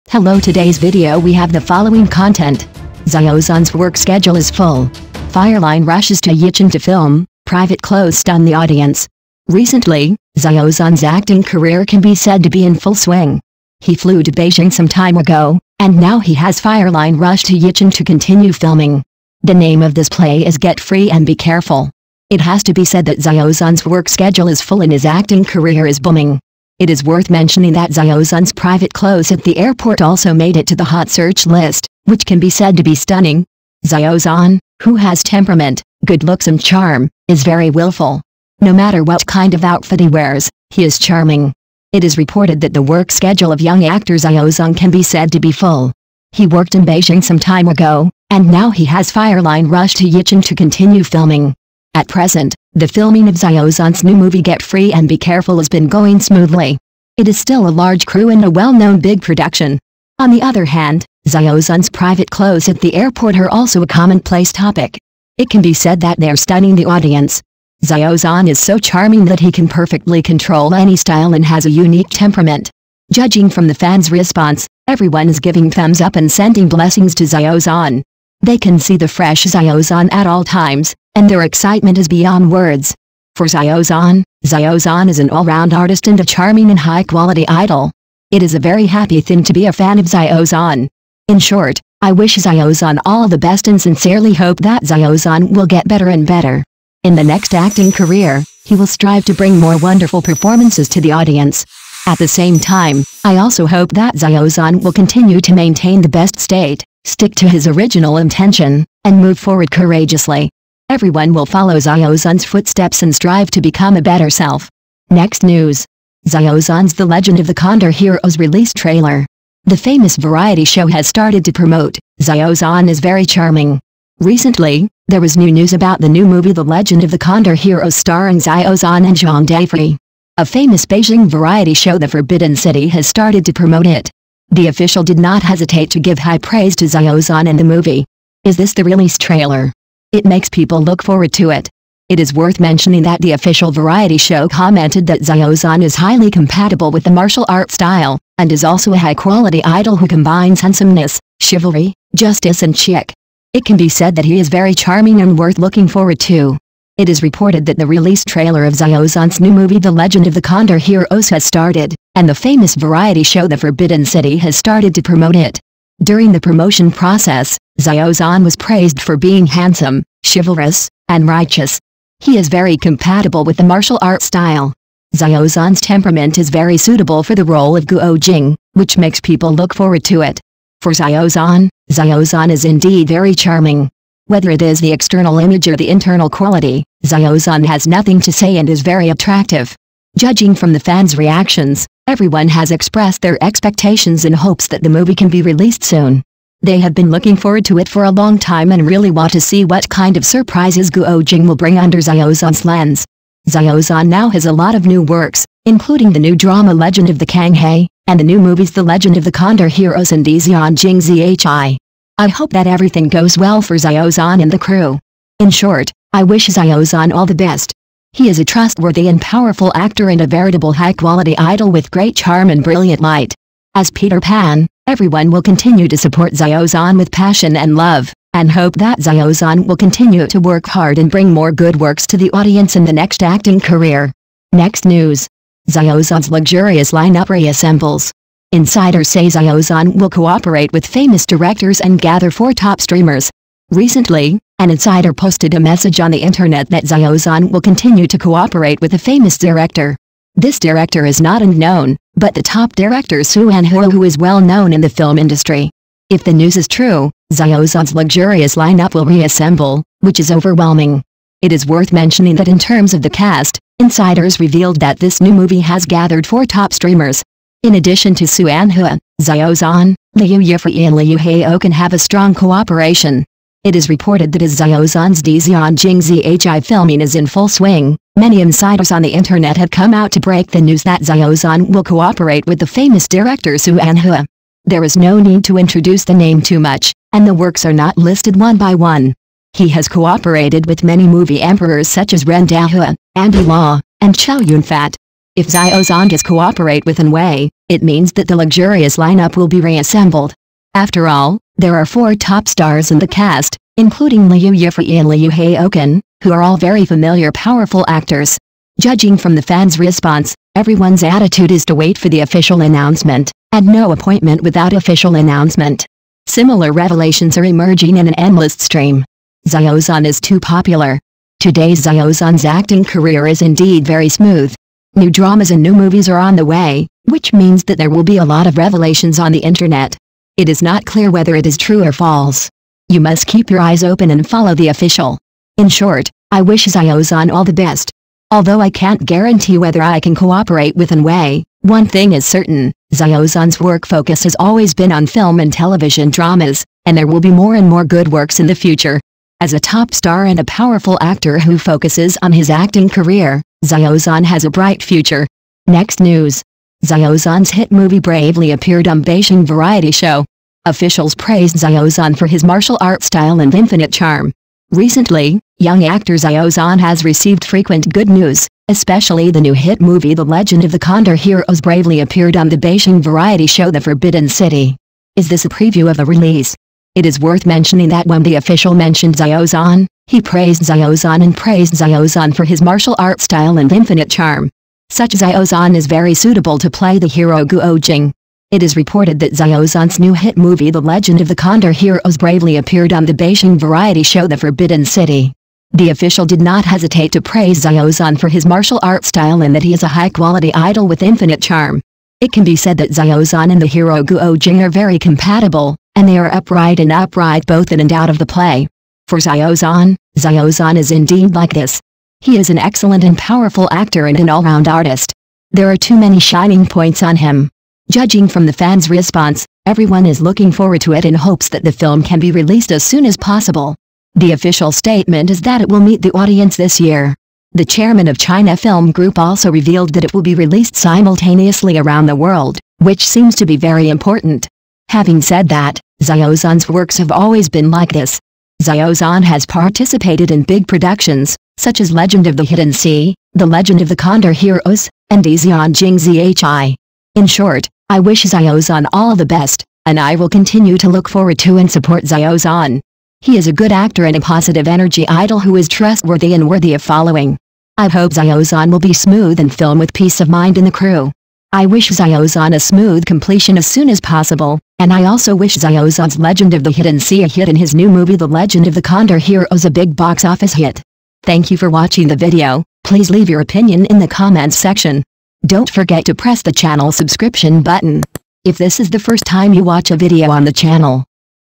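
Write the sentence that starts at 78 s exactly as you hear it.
They can see the fresh Xiao Zhan at all times, and their excitement is beyond words.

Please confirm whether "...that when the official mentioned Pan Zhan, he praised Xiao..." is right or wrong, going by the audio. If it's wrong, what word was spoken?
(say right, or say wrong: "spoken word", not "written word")
wrong: "Xiao", not "Pan".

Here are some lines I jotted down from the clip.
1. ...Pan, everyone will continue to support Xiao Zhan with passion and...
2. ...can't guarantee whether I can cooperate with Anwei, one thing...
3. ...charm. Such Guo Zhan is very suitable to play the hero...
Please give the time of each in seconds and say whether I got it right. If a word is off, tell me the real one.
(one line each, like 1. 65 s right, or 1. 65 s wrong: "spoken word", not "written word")
1. 224 s right
2. 338 s right
3. 384 s wrong: "Xiao", not "Guo".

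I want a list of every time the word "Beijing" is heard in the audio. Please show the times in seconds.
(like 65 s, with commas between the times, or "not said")
14 s, 46 s, 130 s, 359 s, 372 s, 393 s.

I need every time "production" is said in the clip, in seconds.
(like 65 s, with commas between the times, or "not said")
59 s, 440 s.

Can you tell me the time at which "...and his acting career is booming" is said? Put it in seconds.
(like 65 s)
24 s.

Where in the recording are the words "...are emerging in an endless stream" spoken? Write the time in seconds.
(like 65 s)
317 s.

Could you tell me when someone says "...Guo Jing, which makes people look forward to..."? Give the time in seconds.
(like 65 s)
177 s.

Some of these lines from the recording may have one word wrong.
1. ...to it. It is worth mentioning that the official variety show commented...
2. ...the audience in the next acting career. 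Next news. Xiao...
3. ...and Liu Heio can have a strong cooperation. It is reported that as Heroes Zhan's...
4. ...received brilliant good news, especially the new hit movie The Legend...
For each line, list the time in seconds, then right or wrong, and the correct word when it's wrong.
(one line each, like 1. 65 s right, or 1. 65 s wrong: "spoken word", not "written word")
1. 141 s right
2. 232 s right
3. 270 s wrong: "Xiao", not "Heroes"
4. 367 s wrong: "frequent", not "brilliant".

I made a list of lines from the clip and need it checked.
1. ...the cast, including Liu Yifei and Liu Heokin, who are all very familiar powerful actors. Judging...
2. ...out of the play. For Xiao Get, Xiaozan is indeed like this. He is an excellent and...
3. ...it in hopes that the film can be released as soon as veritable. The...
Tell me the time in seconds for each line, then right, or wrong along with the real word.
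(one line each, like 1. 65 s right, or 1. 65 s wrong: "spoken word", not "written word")
1. 302 s right
2. 407 s wrong: "Zhan", not "Get"
3. 420 s wrong: "possible", not "veritable".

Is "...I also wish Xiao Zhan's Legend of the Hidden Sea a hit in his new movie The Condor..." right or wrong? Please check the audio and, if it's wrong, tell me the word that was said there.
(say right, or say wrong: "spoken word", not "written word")
wrong: "Legend", not "Condor".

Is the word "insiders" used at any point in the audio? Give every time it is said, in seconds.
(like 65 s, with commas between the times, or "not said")
238 s, 244 s, 263 s, 278 s.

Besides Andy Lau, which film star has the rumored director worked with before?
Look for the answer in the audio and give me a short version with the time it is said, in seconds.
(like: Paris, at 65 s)
Chow Yun-fat, at 294 s.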